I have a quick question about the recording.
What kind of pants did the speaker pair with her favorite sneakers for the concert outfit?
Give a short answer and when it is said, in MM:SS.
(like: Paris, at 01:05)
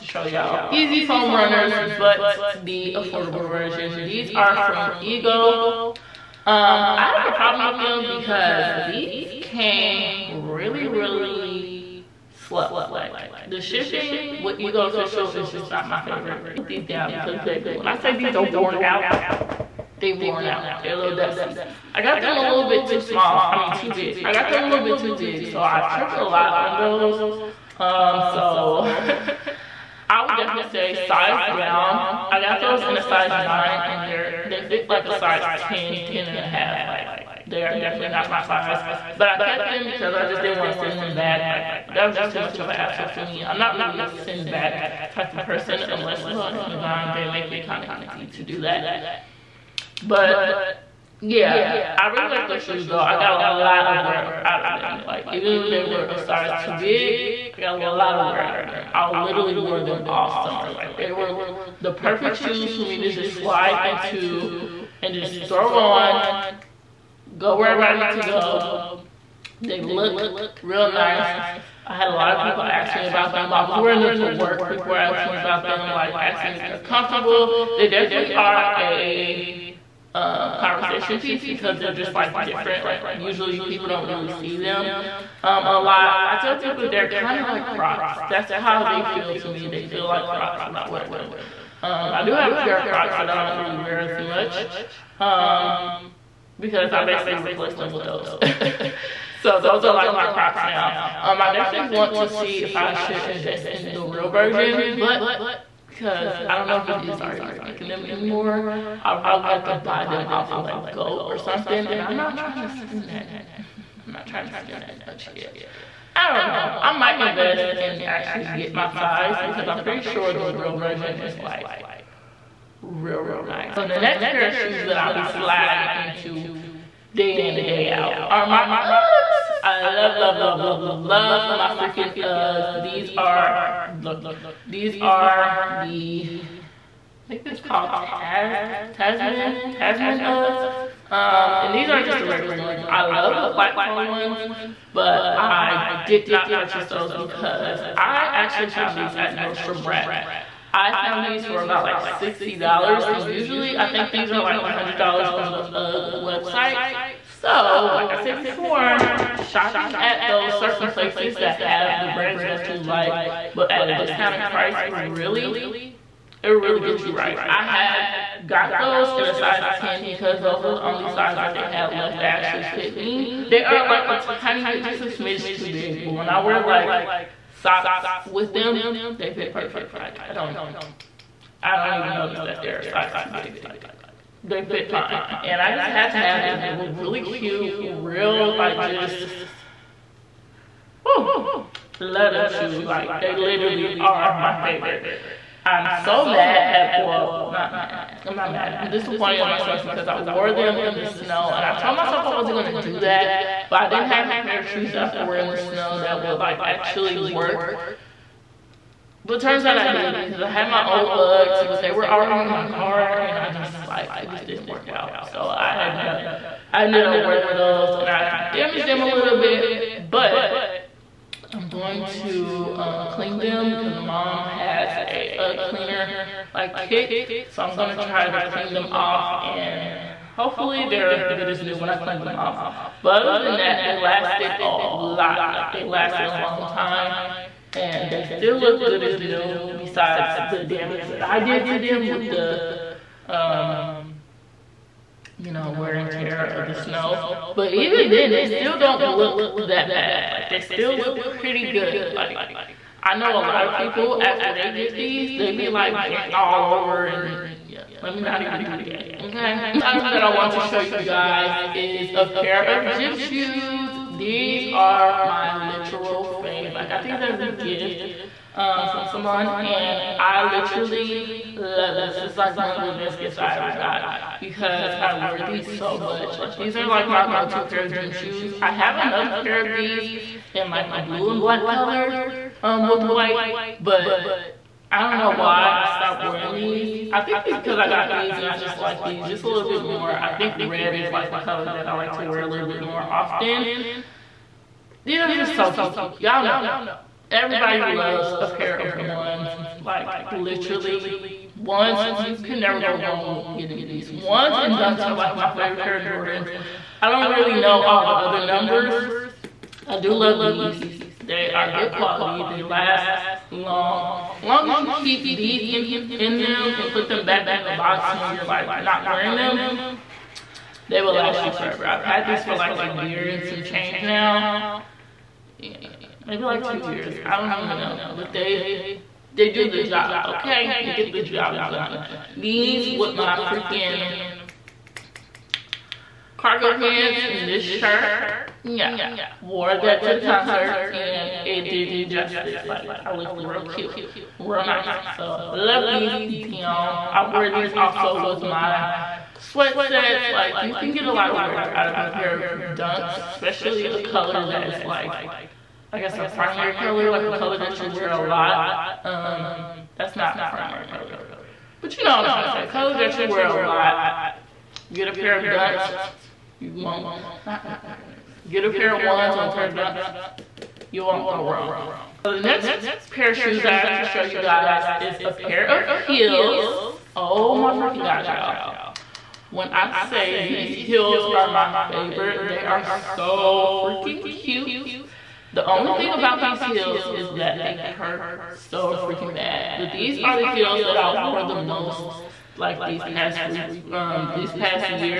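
Cargo pants, at 05:36.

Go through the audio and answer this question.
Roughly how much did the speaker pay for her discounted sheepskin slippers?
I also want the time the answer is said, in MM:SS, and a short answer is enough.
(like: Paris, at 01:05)
$60, at 02:32.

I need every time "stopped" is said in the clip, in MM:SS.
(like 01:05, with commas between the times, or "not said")
04:45.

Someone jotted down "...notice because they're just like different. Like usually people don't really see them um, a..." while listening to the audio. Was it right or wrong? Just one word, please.
wrong.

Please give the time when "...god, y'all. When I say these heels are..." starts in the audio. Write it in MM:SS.
06:18.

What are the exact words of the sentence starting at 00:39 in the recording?
But I kept them because I just didn't want to send them back.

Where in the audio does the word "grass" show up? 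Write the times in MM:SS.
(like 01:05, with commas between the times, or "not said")
not said.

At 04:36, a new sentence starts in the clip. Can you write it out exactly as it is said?
Like these are like my go-to pair of gym shoes.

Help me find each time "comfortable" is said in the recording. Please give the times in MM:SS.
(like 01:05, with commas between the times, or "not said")
01:16.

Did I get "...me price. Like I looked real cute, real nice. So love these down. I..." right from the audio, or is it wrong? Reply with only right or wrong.
wrong.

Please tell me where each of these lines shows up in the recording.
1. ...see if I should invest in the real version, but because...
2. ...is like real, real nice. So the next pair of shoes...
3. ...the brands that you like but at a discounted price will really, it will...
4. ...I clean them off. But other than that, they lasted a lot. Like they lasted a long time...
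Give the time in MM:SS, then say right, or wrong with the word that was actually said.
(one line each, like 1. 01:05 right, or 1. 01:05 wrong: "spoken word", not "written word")
1. 01:42 right
2. 02:01 right
3. 02:42 right
4. 03:51 right.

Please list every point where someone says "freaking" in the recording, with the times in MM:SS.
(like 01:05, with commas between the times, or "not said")
02:11, 05:33, 06:17, 06:23, 06:29.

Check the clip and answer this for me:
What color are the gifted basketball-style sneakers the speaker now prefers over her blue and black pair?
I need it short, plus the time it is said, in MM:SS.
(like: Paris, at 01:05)
Red, at 04:50.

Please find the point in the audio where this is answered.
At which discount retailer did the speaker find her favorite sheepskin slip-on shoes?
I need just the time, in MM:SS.
02:29.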